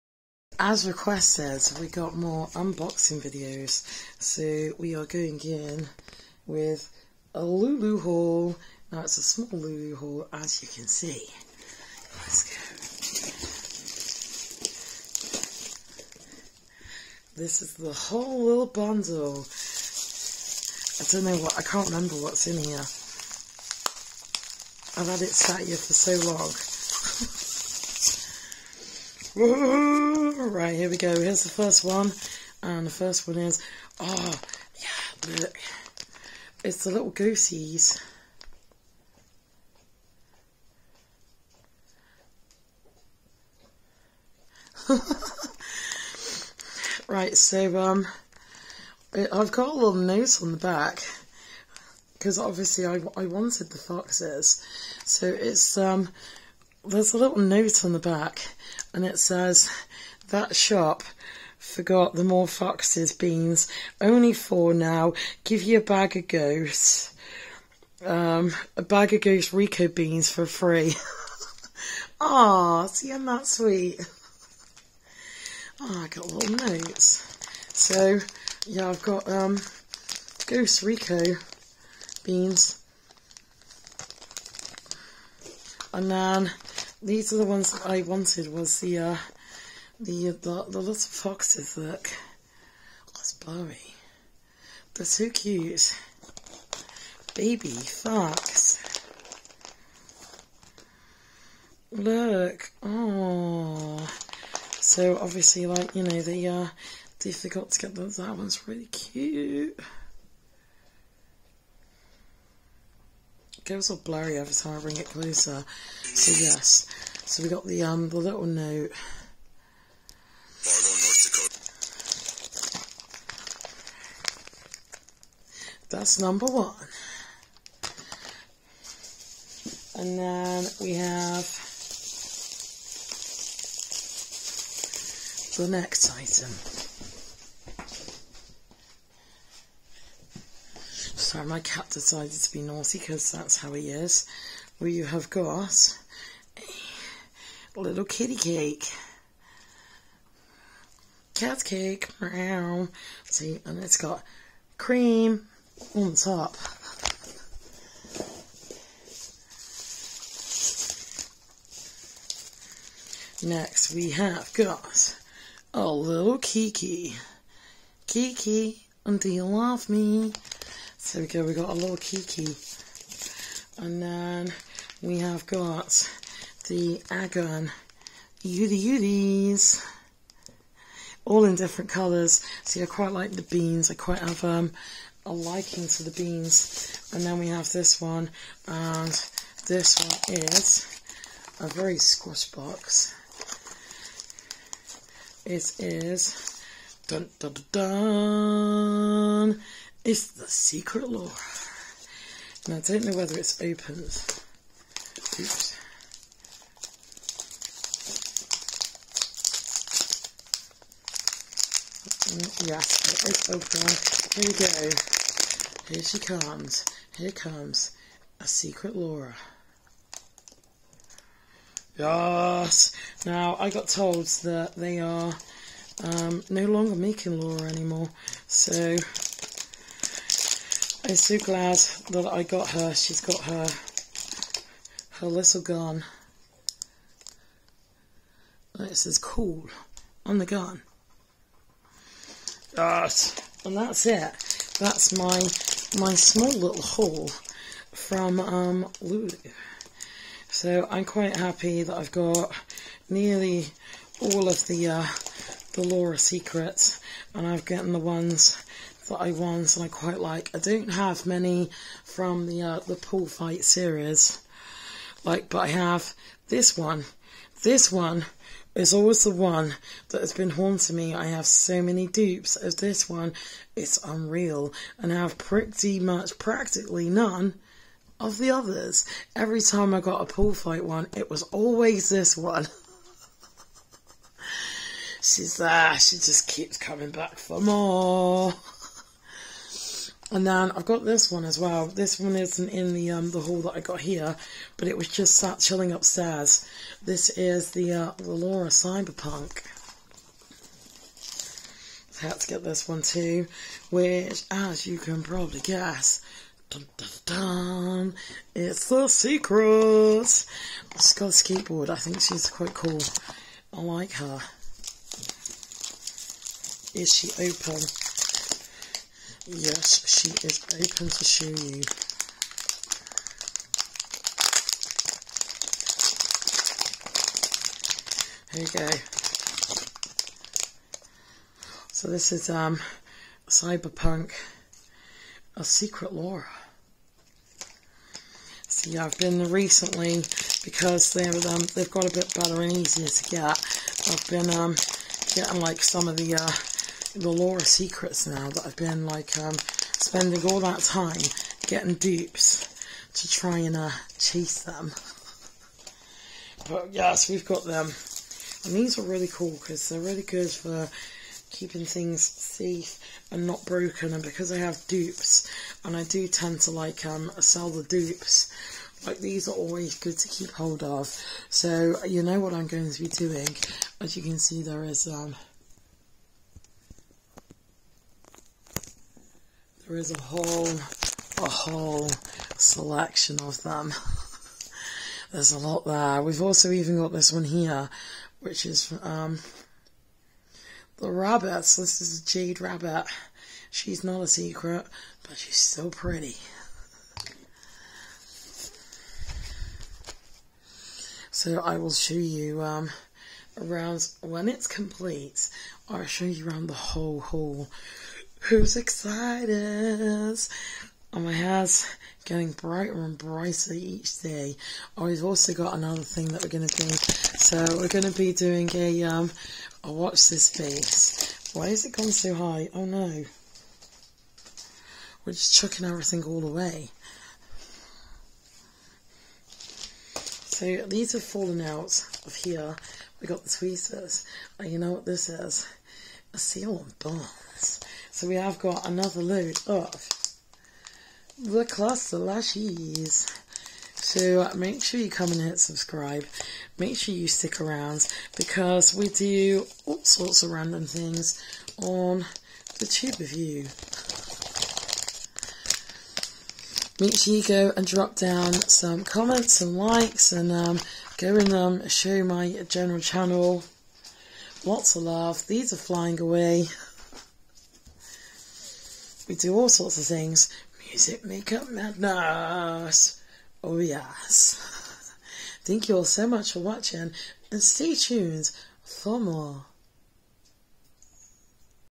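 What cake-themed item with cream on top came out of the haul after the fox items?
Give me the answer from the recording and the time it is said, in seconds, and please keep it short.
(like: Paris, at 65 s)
Cat cake, at 151 s.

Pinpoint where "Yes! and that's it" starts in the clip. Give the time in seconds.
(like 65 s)
242 s.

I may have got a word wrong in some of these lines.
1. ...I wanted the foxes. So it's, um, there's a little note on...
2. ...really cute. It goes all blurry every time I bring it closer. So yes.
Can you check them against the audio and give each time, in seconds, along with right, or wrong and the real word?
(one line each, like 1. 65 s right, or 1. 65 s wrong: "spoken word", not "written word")
1. 53 s right
2. 108 s right.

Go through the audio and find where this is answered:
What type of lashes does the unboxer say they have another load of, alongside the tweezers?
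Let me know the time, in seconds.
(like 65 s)
441 s.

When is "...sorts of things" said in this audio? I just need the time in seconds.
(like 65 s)
469 s.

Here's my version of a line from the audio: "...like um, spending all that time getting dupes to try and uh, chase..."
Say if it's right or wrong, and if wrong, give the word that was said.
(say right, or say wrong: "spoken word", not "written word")
right.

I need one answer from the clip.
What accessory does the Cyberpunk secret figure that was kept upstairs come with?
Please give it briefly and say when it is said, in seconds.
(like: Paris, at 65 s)
A skateboard, at 311 s.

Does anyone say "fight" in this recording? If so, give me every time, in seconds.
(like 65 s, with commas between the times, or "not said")
263 s, 280 s.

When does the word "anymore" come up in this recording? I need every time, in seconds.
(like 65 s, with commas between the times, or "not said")
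227 s.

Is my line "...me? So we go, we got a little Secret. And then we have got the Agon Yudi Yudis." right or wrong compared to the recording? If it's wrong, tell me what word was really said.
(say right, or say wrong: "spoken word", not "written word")
wrong: "Kiki", not "Secret".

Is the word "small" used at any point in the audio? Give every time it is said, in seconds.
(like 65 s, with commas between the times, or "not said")
9 s, 246 s.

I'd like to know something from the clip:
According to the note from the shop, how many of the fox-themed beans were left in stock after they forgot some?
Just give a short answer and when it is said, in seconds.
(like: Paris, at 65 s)
4, at 64 s.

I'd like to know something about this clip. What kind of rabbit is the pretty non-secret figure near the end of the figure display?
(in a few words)
Jade rabbit.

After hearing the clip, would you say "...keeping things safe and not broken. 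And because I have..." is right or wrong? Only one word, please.
right.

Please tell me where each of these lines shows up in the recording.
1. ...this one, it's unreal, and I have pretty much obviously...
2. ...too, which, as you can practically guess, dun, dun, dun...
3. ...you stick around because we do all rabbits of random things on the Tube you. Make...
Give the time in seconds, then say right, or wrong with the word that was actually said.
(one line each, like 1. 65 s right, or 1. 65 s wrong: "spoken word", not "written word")
1. 272 s wrong: "practically", not "obviously"
2. 303 s wrong: "probably", not "practically"
3. 447 s wrong: "sorts", not "rabbits".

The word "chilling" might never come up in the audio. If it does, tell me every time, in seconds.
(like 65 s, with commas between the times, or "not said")
295 s.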